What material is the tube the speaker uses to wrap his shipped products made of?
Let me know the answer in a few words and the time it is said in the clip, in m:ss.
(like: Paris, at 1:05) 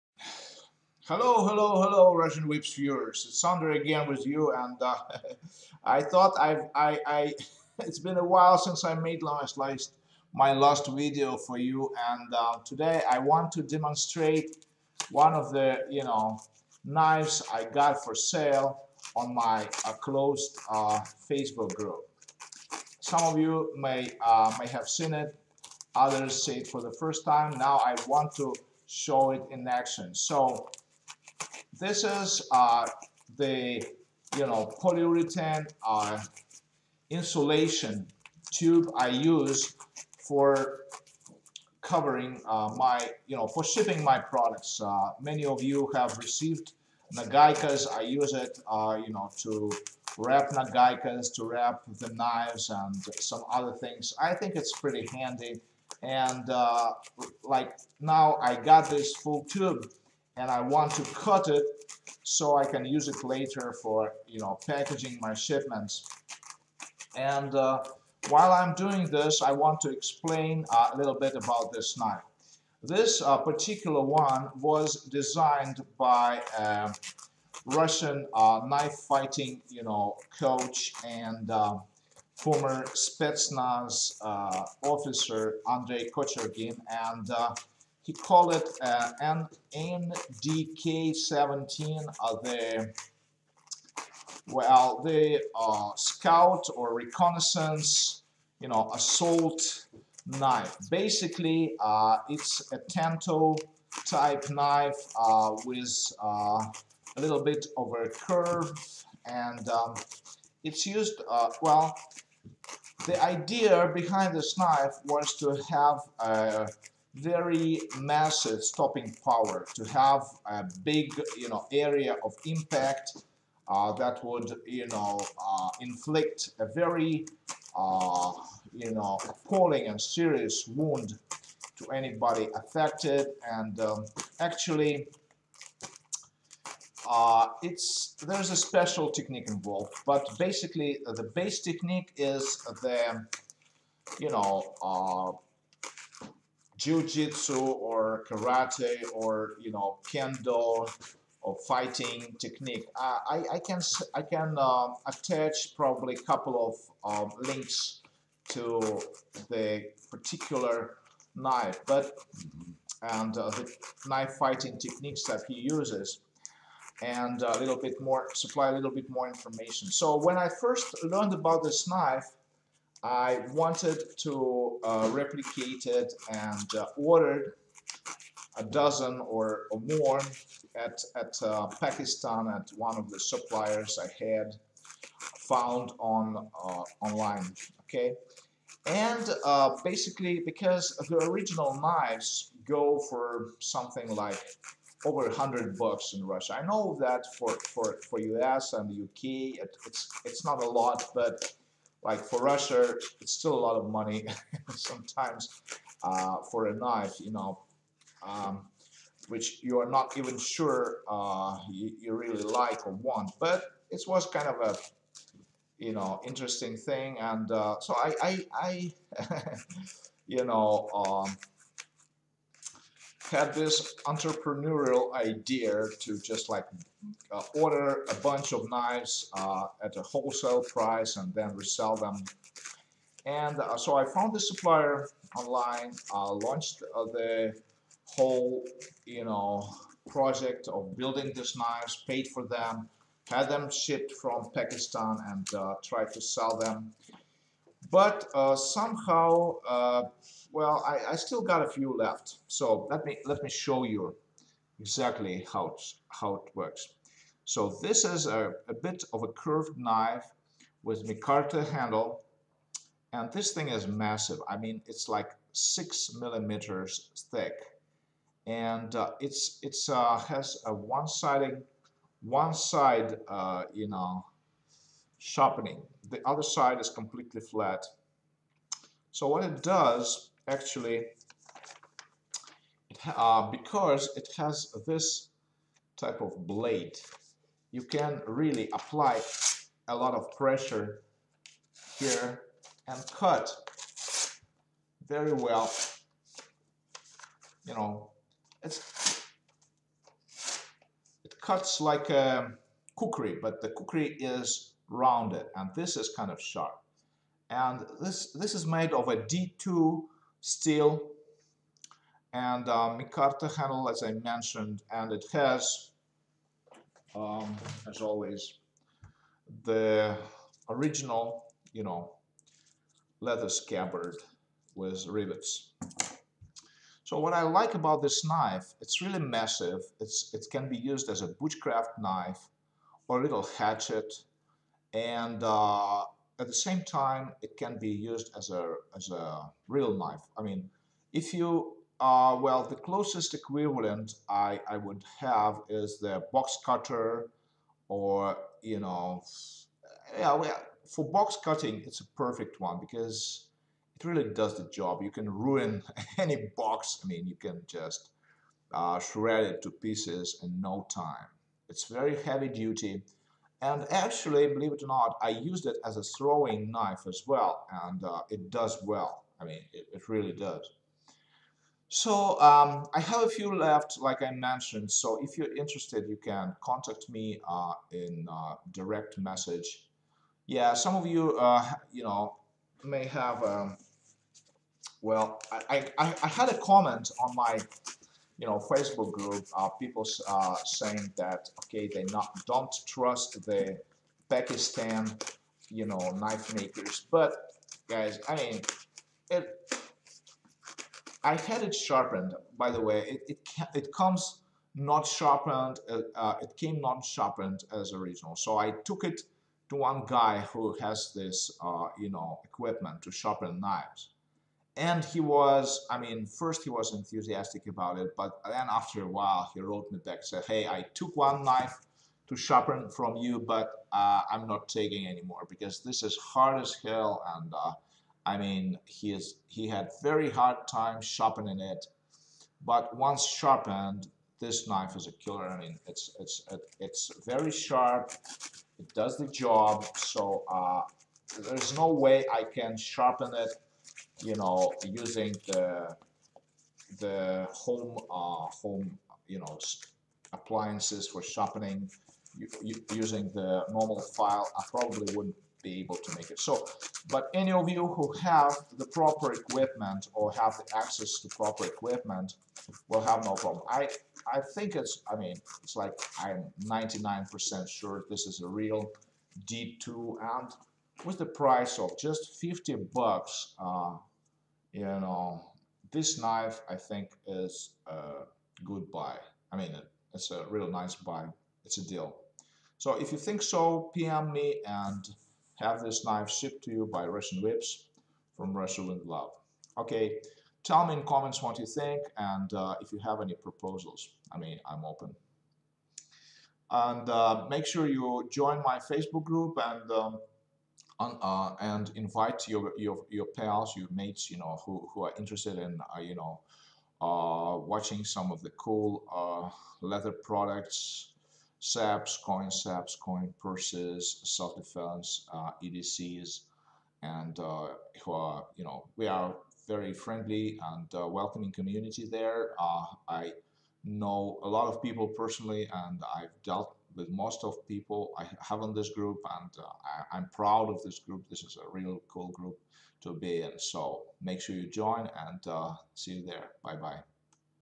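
Polyurethane, at 0:34.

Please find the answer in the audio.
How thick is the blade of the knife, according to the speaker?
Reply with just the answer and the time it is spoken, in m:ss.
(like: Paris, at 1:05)
6 millimeters, at 4:25.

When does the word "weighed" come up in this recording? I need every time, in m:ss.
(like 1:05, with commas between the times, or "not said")
not said.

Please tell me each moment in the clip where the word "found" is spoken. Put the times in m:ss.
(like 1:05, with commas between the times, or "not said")
3:05, 3:54.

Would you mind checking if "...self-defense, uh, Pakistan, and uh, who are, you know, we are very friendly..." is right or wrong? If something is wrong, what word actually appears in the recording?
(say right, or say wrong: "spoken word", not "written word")
wrong: "EDCs", not "Pakistan".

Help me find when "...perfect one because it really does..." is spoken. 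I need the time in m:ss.
5:52.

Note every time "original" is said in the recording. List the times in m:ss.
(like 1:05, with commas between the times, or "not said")
3:11, 5:20, 6:47.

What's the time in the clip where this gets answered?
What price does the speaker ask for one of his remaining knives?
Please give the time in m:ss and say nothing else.
7:52.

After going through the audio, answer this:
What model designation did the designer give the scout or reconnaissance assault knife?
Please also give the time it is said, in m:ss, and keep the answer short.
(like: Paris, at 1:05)
NDK-17, at 1:29.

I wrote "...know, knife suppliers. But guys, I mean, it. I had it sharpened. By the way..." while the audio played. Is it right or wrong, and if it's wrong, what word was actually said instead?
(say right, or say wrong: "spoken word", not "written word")
wrong: "makers", not "suppliers".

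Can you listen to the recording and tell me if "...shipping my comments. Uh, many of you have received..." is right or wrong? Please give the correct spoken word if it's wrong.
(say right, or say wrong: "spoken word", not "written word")
wrong: "products", not "comments".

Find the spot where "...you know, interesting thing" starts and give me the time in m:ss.
3:35.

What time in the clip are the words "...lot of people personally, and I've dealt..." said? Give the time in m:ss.
8:44.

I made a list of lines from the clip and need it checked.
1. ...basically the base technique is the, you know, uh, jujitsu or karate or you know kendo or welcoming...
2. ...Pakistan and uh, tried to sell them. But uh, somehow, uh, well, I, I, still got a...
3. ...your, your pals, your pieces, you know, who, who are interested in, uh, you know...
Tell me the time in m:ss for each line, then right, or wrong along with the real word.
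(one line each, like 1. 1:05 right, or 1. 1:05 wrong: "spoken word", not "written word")
1. 2:20 wrong: "fighting", not "welcoming"
2. 4:04 right
3. 8:22 wrong: "mates", not "pieces".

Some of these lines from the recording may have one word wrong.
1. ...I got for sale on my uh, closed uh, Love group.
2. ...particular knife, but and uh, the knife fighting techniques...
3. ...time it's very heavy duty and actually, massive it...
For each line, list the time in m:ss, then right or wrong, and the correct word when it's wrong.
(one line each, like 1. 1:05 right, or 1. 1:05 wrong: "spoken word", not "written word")
1. 0:17 wrong: "Facebook", not "Love"
2. 2:40 right
3. 6:00 wrong: "believe", not "massive".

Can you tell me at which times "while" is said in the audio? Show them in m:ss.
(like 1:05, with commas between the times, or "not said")
0:08, 1:08, 6:59.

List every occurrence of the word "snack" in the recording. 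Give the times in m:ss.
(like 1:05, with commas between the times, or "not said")
not said.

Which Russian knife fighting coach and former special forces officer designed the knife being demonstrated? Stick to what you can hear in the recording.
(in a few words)
Andrei Kochergin.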